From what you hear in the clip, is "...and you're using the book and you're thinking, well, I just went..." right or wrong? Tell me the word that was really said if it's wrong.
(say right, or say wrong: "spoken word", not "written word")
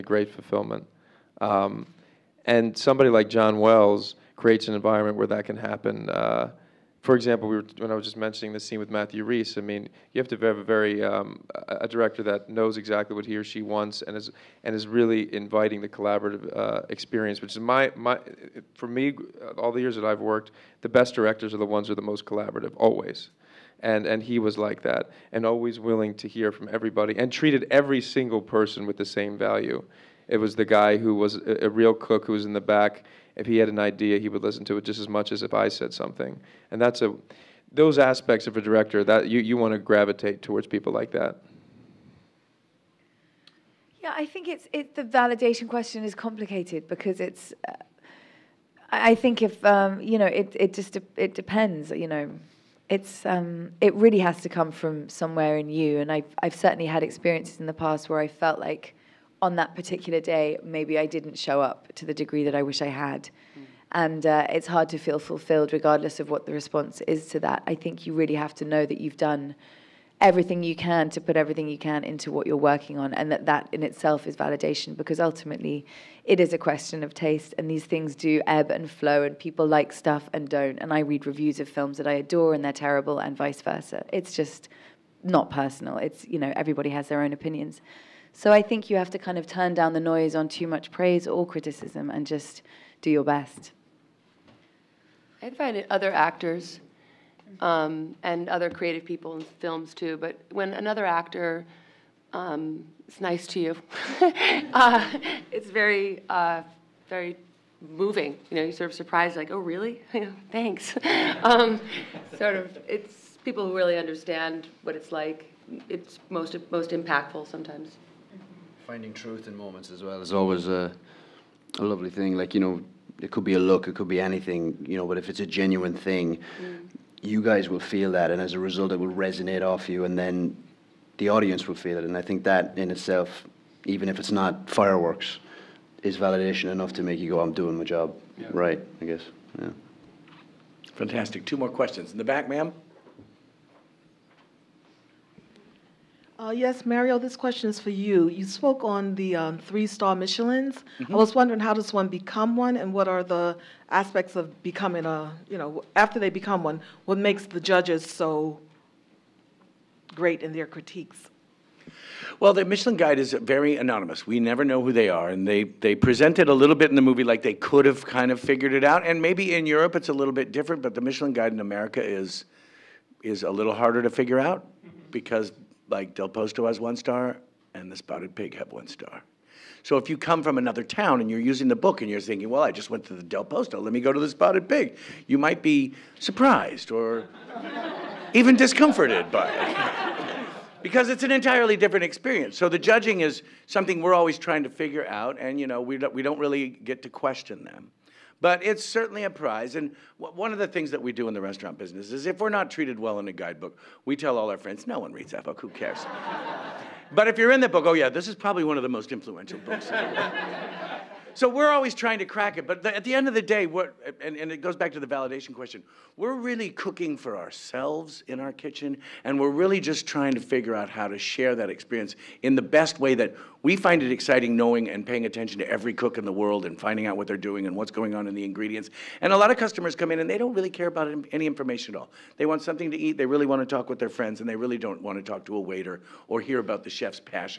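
right.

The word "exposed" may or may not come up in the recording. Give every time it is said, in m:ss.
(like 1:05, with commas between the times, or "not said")
not said.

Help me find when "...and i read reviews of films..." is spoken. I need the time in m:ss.
1:20.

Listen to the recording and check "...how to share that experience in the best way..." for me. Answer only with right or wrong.
right.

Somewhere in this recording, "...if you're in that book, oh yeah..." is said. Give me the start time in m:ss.
3:27.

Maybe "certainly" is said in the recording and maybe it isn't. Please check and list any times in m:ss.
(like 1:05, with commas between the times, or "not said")
0:56, 3:18.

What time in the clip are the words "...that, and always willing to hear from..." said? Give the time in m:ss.
0:24.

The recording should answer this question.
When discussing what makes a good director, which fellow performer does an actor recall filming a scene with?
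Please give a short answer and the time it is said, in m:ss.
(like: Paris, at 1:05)
Matthew Rhys, at 0:08.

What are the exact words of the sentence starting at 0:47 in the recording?
Uh, I think if um, you know, it it just de- it depends.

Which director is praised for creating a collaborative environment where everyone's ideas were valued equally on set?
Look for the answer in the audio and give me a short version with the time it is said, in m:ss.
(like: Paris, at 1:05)
John Wells, at 0:03.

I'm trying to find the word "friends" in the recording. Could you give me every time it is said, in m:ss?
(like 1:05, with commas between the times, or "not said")
3:24, 3:54.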